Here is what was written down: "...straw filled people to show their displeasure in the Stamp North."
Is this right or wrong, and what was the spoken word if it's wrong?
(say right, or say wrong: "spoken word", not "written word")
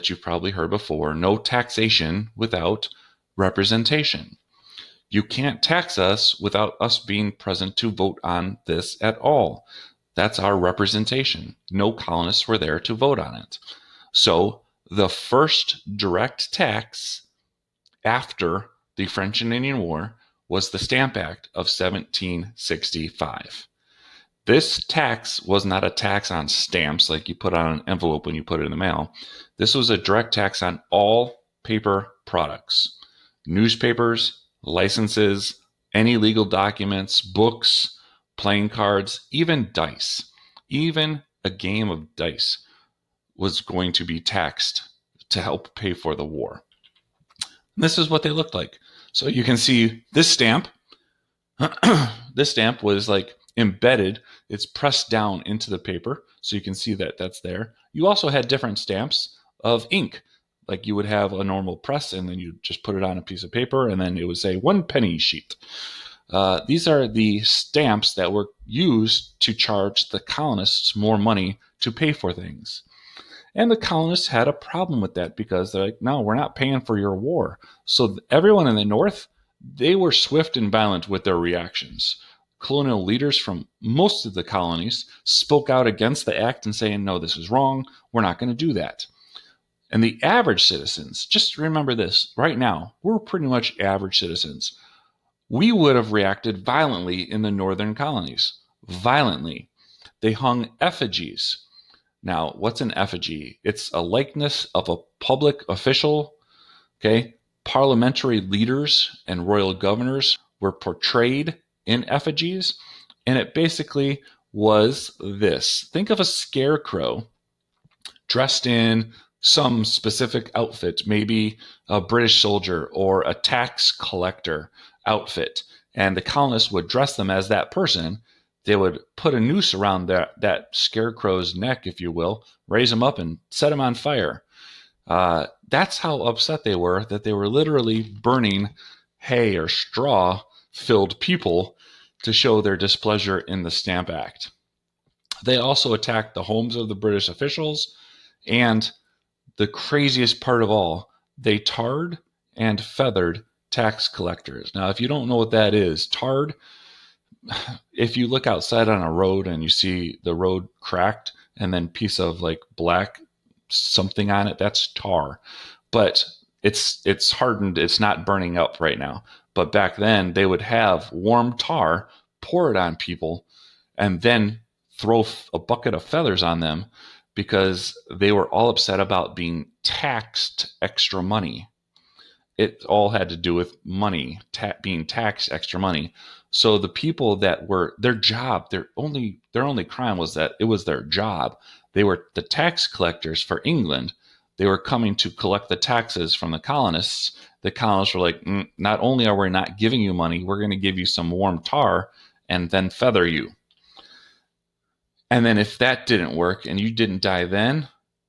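wrong: "Act", not "North".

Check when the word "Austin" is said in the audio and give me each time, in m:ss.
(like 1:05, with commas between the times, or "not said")
not said.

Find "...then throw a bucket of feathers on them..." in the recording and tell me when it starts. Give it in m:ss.
2:54.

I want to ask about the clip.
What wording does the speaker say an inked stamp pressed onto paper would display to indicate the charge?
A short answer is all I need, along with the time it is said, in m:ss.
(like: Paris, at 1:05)
one penny sheet, at 1:04.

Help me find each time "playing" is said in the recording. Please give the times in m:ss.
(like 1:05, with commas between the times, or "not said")
0:38.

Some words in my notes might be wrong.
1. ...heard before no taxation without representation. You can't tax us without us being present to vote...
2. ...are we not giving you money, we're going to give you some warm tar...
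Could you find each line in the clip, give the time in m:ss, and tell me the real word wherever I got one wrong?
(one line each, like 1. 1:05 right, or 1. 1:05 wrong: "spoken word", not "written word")
1. 0:00 right
2. 3:19 right.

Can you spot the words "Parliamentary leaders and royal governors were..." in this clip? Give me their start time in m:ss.
1:47.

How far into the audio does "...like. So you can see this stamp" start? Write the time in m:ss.
0:48.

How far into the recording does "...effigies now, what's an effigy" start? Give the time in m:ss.
1:40.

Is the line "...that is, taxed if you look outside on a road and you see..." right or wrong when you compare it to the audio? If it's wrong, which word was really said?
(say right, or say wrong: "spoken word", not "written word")
wrong: "tarred", not "taxed".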